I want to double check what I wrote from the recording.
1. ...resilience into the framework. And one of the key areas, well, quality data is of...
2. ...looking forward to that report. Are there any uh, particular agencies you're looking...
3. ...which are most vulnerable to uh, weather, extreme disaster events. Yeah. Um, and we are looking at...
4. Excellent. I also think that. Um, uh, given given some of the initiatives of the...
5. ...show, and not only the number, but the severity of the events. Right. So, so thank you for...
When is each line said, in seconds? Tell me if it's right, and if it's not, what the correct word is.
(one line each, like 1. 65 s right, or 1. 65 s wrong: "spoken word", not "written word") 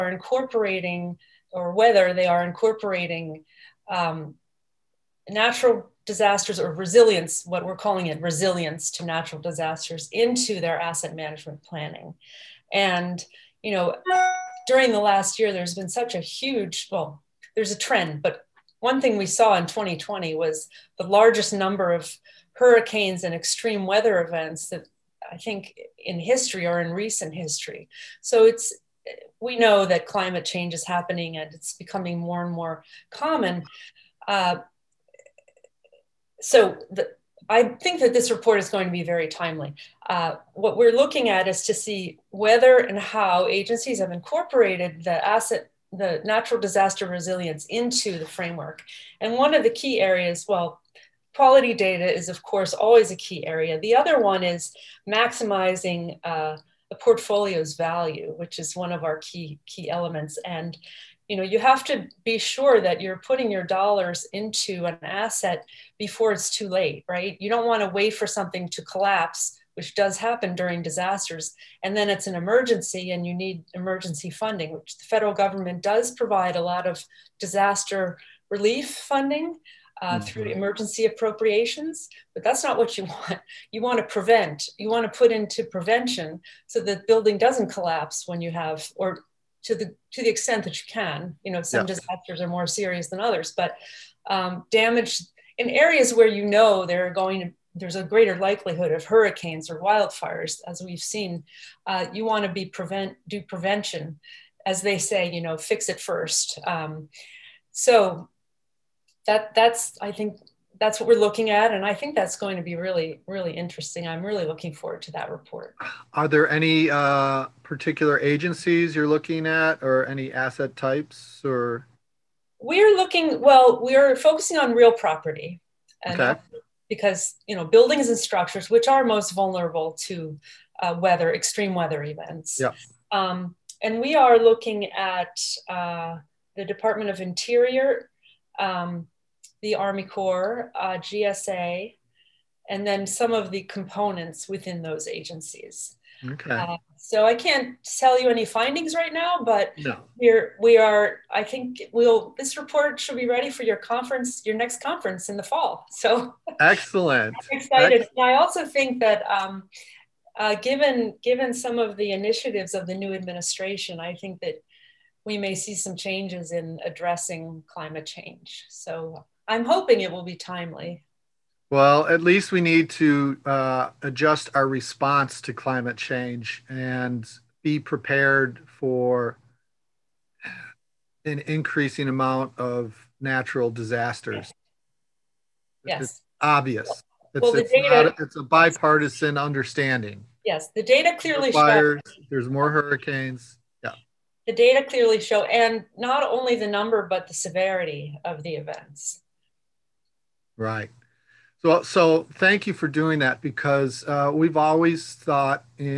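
1. 47 s right
2. 114 s right
3. 128 s wrong: "weather", not "disaster"
4. 158 s right
5. 195 s right.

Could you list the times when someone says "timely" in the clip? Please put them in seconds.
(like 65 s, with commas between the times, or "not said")
39 s, 170 s.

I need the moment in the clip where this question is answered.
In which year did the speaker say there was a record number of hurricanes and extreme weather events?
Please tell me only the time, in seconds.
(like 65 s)
19 s.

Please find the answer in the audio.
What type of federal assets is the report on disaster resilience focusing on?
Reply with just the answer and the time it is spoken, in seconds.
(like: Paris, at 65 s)
Real property, at 124 s.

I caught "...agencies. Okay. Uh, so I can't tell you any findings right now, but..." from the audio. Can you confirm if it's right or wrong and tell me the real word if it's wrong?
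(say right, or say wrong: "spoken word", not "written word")
right.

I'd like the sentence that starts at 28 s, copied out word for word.
So it's we know that climate change is happening and it's becoming more and more common.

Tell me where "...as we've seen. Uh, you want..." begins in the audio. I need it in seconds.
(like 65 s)
100 s.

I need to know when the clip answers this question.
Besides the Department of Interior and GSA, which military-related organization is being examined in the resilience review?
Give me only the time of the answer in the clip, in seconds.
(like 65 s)
139 s.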